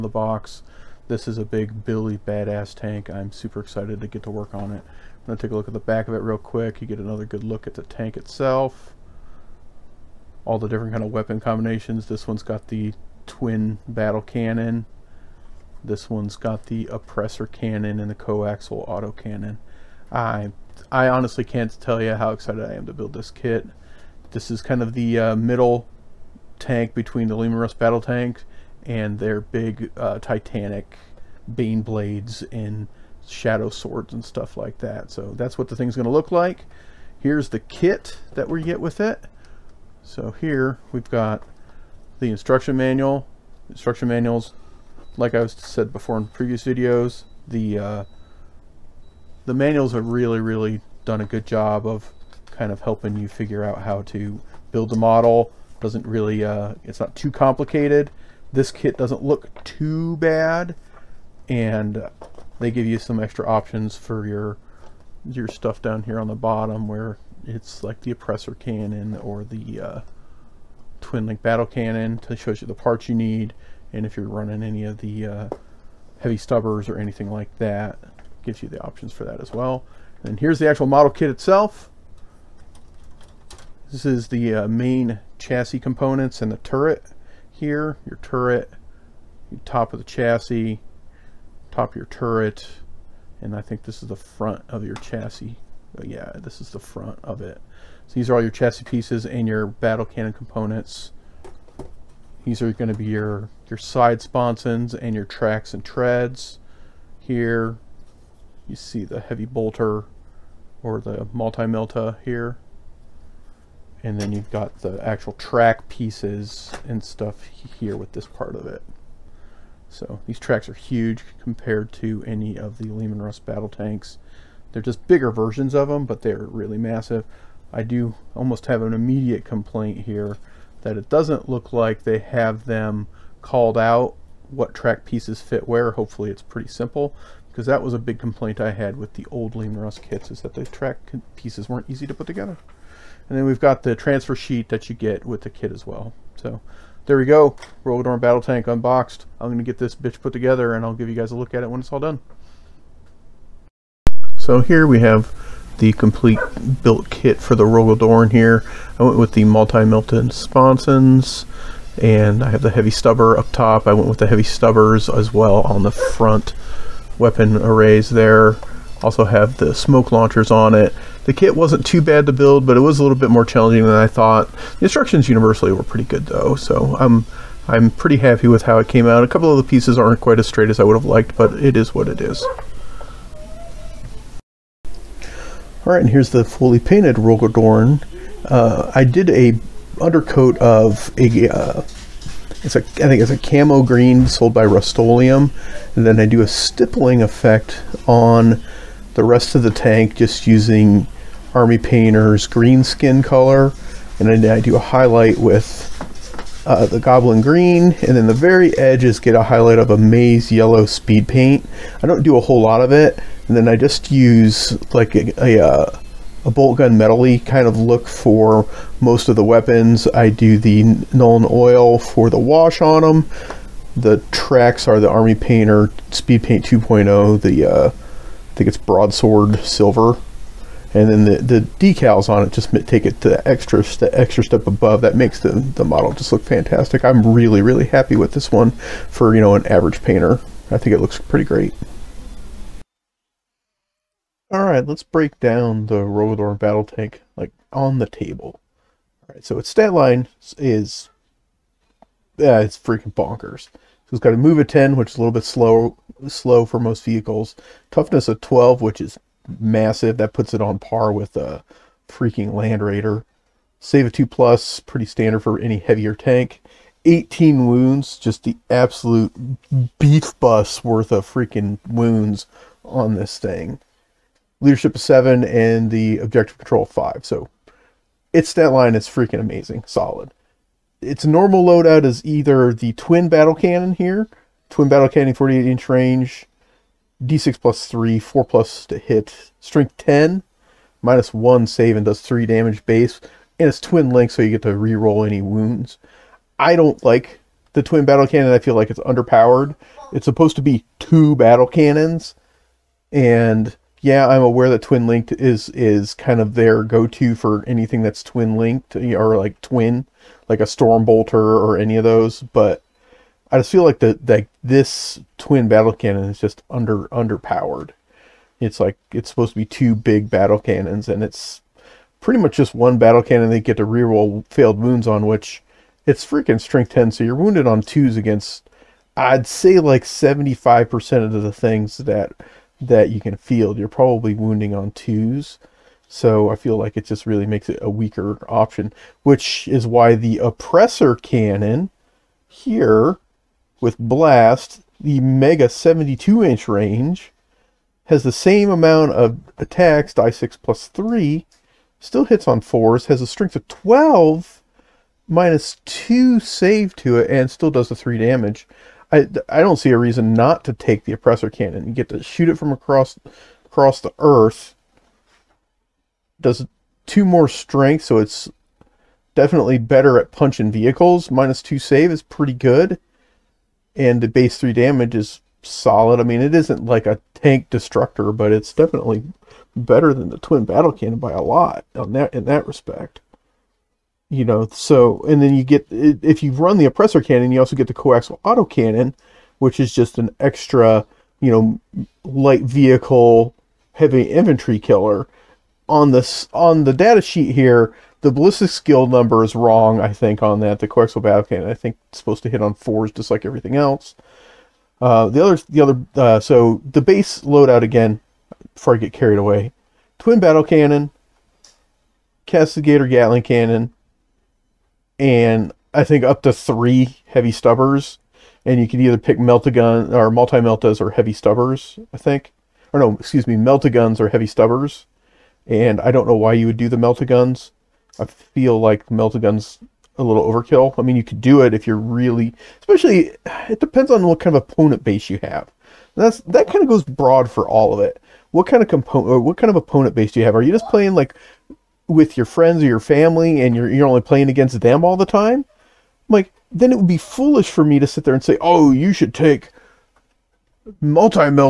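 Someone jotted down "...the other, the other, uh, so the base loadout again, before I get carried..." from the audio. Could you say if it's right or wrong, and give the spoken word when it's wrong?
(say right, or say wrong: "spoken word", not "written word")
right.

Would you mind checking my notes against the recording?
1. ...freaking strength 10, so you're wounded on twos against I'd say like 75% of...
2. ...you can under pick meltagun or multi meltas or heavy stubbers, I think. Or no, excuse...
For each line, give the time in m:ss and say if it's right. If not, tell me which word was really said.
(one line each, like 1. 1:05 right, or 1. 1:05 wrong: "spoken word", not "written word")
1. 5:26 right
2. 6:58 wrong: "either", not "under".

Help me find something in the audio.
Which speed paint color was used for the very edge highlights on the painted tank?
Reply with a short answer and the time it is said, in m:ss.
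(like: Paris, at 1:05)
maize yellow, at 3:29.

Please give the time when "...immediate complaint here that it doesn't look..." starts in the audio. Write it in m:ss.
2:08.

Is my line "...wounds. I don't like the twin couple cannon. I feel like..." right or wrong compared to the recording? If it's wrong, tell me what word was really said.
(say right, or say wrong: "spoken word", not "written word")
wrong: "battle", not "couple".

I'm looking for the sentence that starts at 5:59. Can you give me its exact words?
I, I don't see a reason not to take the Oppressor Cannon.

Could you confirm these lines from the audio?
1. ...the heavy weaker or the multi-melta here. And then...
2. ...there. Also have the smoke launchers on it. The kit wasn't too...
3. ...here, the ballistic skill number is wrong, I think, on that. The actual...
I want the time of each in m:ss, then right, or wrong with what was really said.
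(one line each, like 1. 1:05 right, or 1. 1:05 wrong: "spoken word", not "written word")
1. 1:49 wrong: "bolter", not "weaker"
2. 2:48 right
3. 6:37 wrong: "coaxial", not "actual".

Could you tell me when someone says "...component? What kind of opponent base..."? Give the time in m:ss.
7:18.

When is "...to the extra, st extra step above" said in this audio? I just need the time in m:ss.
3:53.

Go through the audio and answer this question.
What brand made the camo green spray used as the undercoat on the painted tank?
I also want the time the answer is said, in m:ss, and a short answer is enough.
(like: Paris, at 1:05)
Rust-Oleum, at 3:14.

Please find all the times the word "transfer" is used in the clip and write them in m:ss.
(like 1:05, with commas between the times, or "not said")
2:23.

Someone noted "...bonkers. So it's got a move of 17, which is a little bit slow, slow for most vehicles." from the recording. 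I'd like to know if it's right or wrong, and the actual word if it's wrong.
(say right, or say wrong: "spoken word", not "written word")
wrong: "10", not "17".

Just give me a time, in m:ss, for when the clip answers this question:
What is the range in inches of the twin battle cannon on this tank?
4:45.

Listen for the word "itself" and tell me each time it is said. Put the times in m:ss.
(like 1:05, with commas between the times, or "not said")
0:08, 1:21.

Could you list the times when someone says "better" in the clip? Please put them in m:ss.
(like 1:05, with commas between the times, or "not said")
6:09, 6:19.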